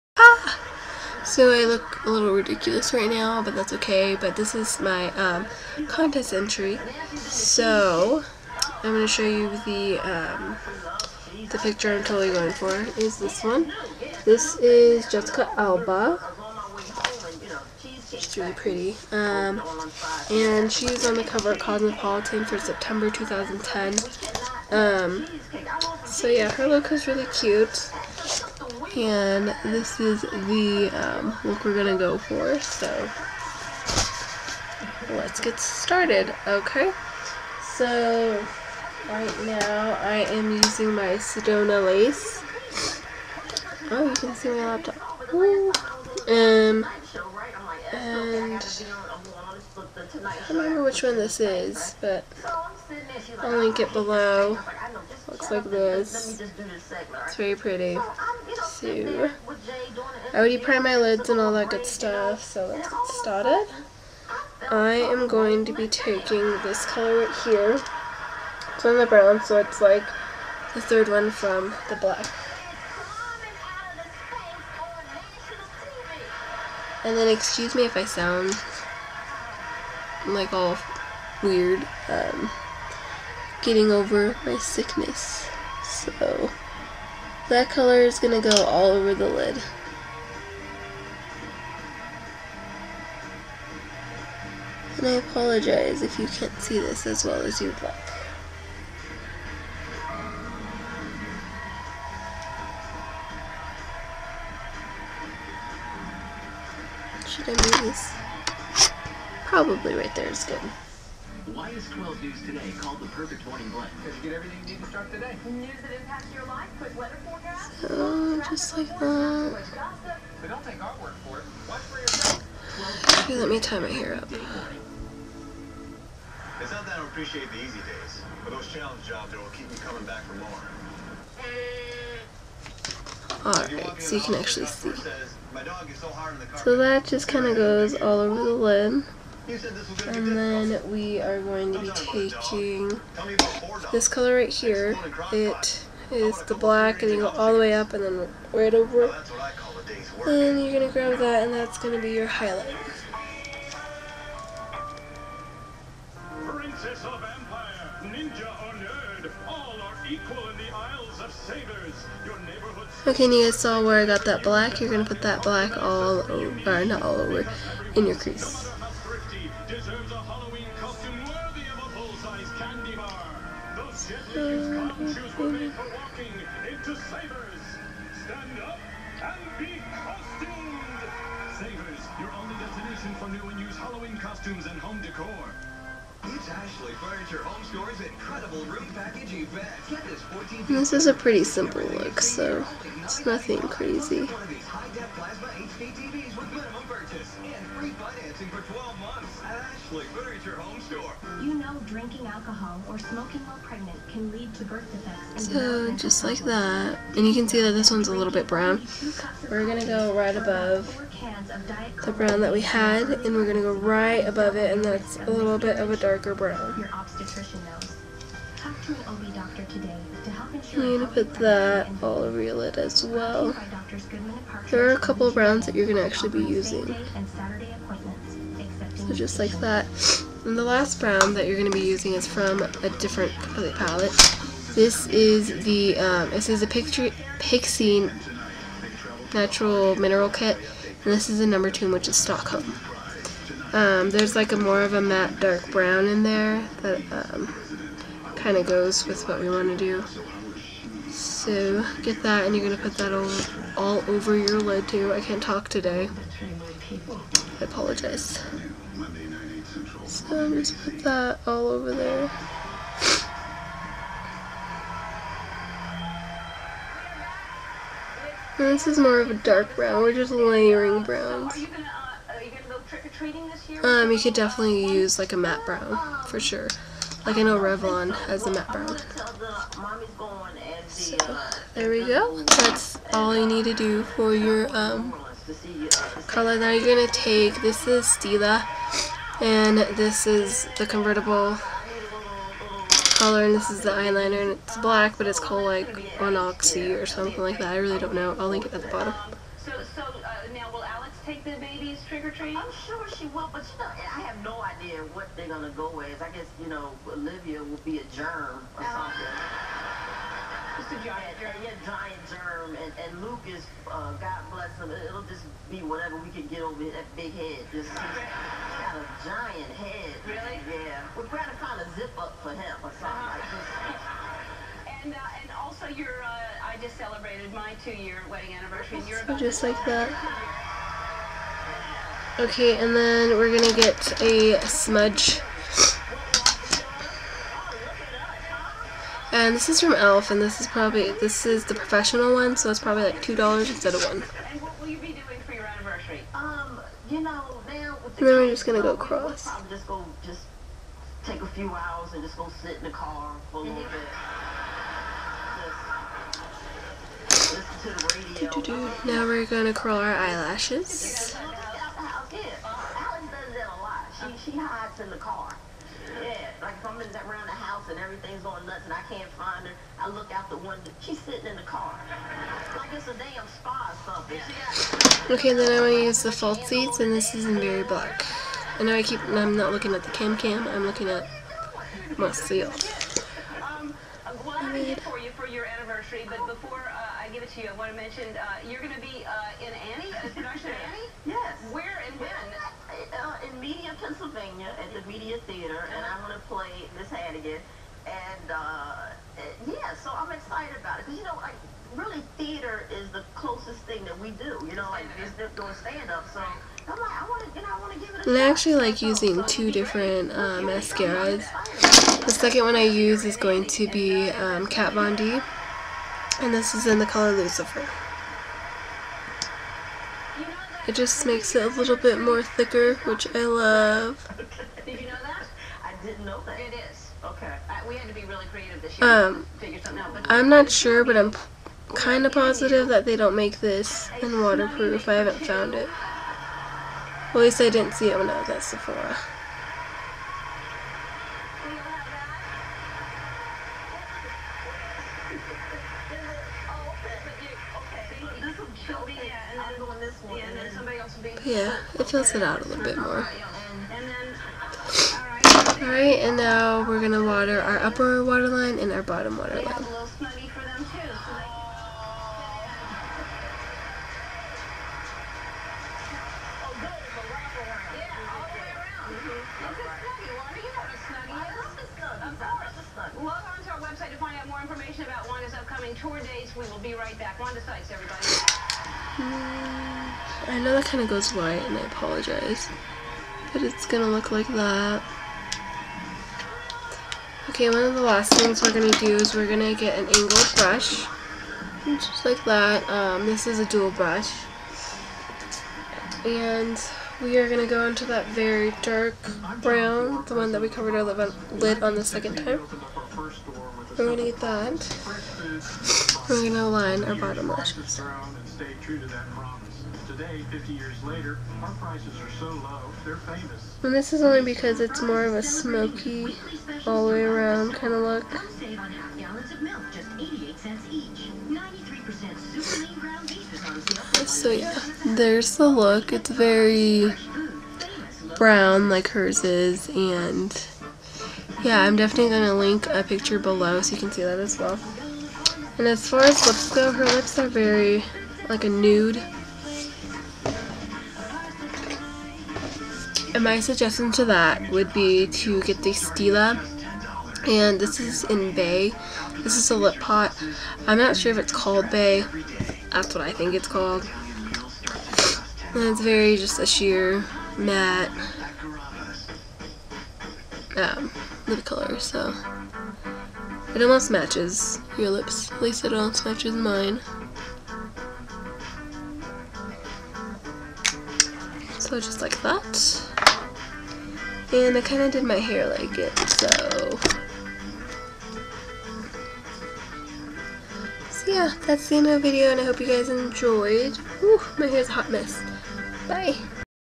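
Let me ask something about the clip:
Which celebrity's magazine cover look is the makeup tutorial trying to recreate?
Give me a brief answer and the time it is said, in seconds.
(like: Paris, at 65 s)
Jessica Alba, at 15 s.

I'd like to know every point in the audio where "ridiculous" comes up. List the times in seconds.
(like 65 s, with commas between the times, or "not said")
2 s.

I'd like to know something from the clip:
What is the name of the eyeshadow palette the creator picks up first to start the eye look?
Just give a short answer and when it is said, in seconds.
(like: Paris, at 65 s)
Sedona lace, at 41 s.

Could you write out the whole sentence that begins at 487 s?
Okay, one of the last things we're going to do is we're going to get an angled brush.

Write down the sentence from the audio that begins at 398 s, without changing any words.
And, uh, yeah, so I'm excited about it.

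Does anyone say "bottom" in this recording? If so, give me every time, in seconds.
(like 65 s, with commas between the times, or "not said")
298 s, 459 s, 507 s.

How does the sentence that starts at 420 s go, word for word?
It just makes it a little bit more thicker, which I love.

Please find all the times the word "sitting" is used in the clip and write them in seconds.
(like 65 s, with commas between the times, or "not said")
371 s.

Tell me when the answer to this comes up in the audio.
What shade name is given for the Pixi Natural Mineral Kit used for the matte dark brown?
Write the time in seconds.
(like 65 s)
242 s.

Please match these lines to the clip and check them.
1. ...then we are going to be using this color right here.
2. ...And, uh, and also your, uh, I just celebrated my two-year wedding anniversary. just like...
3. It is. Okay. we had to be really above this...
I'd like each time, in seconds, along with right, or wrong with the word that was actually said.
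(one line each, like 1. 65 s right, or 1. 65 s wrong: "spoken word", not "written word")
1. 140 s wrong: "taking", not "using"
2. 325 s right
3. 426 s wrong: "creative", not "above".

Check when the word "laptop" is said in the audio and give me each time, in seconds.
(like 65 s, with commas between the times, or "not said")
44 s.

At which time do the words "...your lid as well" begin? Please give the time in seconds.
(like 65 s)
222 s.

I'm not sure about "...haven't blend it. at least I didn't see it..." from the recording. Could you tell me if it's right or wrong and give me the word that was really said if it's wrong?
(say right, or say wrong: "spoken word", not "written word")
wrong: "found", not "blend".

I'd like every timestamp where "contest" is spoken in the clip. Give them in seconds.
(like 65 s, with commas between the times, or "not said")
5 s.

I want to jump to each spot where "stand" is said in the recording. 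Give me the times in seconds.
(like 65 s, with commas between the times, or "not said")
178 s, 405 s.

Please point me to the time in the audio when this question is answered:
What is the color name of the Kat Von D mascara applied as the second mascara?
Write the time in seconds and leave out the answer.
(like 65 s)
417 s.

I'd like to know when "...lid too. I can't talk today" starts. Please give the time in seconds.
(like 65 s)
254 s.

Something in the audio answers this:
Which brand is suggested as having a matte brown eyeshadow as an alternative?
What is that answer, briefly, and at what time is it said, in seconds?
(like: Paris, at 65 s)
Revlon, at 277 s.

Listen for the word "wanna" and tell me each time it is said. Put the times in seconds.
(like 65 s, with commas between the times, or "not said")
407 s.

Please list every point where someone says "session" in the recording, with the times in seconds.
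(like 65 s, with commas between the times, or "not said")
not said.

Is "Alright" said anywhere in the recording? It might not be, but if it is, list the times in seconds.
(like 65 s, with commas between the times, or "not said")
133 s, 455 s.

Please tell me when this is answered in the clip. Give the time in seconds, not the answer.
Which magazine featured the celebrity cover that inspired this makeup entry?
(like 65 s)
21 s.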